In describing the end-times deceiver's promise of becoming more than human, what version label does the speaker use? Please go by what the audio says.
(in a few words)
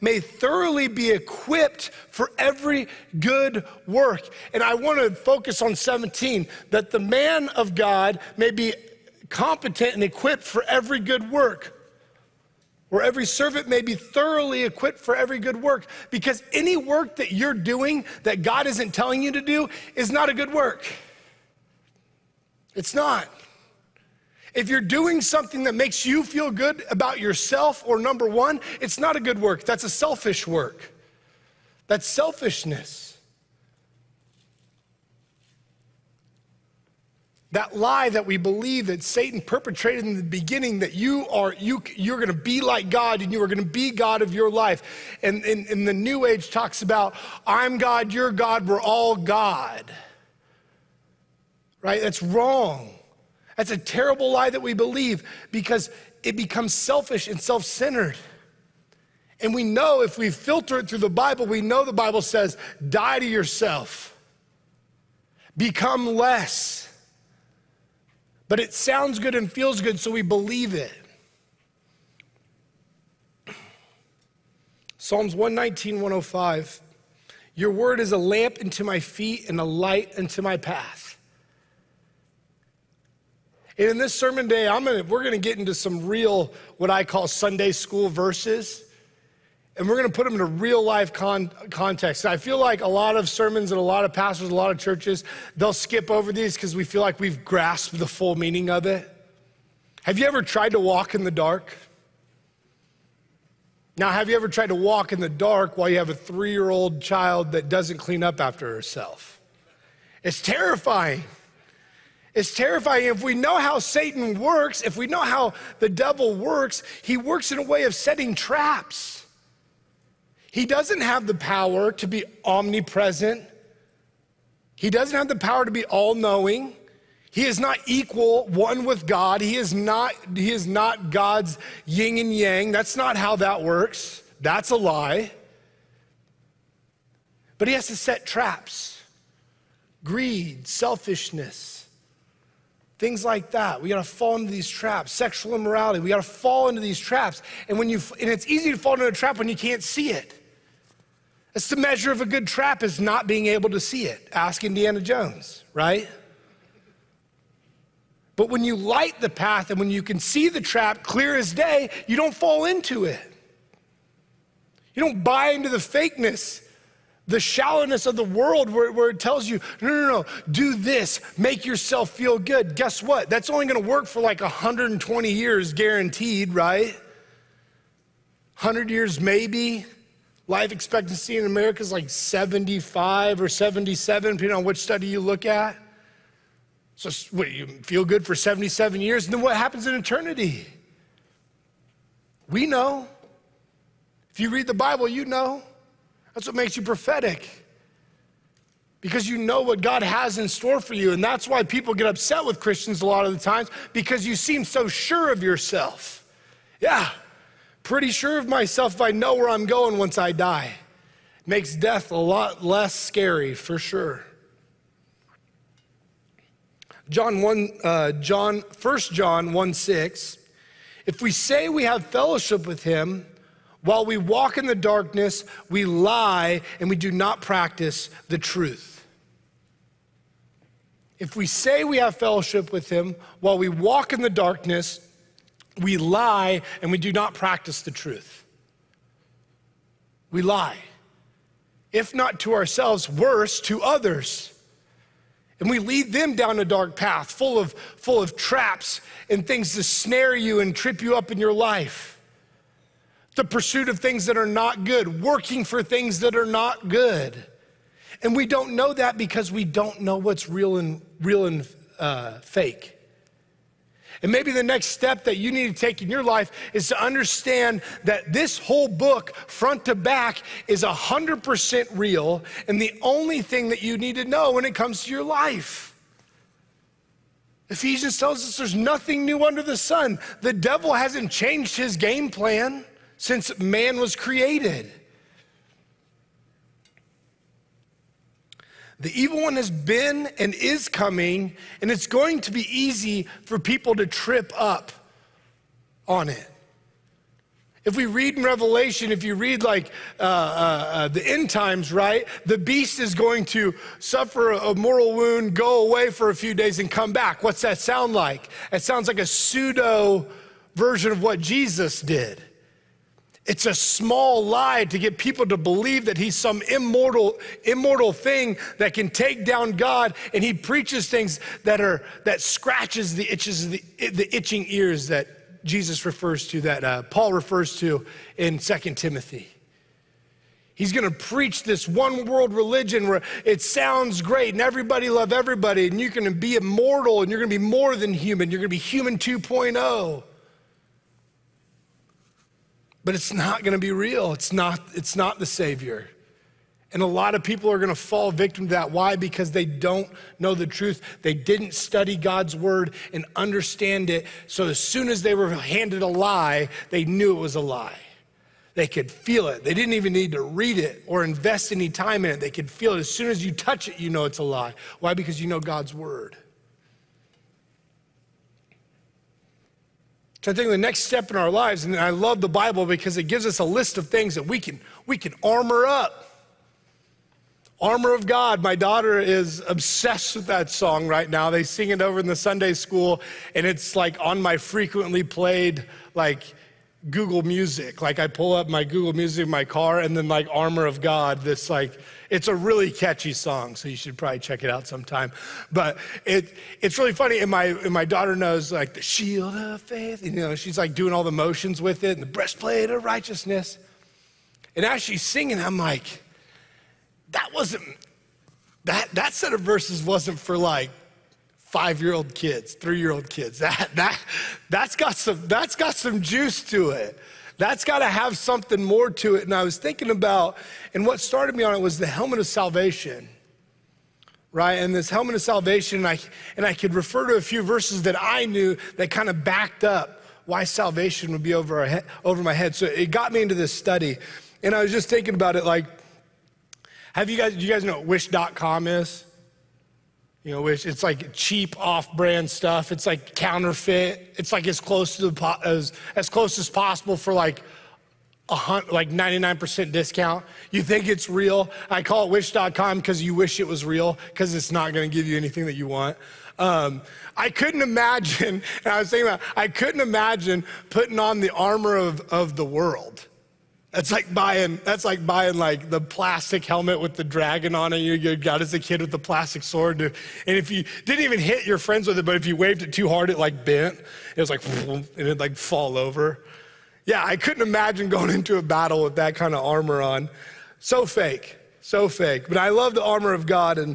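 human 2.0.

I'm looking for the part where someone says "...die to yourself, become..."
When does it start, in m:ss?
1:02.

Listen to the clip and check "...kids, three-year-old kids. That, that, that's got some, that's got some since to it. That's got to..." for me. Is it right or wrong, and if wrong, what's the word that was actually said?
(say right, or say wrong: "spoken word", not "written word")
wrong: "juice", not "since".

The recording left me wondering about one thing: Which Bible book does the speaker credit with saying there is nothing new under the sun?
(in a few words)
Ephesians.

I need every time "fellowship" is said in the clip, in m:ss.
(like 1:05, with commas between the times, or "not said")
3:42, 3:52.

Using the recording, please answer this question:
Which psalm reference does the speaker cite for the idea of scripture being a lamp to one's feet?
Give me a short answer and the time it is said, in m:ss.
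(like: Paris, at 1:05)
Psalms 119:105, at 1:14.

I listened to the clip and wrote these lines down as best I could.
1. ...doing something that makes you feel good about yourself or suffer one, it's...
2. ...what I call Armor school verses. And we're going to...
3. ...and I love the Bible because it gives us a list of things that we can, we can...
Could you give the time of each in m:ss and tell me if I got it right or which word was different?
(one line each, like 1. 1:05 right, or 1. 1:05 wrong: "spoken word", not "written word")
1. 0:24 wrong: "number", not "suffer"
2. 1:26 wrong: "Sunday", not "Armor"
3. 6:11 right.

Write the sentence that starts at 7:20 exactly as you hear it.
you know, which it's like cheap off-brand stuff.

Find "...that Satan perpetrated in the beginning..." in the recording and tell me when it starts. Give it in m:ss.
0:38.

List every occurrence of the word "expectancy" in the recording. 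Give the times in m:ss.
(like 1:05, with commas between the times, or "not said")
3:00.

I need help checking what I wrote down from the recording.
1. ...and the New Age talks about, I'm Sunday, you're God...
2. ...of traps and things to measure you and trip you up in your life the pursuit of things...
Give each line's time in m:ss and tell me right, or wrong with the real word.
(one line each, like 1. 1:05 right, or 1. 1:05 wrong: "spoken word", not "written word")
1. 0:45 wrong: "God", not "Sunday"
2. 4:08 wrong: "snare", not "measure".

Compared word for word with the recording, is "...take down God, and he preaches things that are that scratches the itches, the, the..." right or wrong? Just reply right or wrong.
right.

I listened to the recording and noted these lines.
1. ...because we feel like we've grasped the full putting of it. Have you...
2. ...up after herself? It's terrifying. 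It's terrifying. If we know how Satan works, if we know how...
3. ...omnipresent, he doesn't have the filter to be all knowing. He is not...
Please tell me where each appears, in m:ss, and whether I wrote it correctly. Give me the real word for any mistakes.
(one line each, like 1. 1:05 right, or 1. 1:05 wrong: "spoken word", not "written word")
1. 1:36 wrong: "meaning", not "putting"
2. 1:48 right
3. 2:02 wrong: "power", not "filter".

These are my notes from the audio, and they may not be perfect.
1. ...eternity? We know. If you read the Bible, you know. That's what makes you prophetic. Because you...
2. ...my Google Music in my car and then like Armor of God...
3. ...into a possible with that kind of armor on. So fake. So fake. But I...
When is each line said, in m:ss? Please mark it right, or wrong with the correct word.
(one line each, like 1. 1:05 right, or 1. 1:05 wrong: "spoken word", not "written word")
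1. 3:09 right
2. 6:28 right
3. 7:58 wrong: "battle", not "possible".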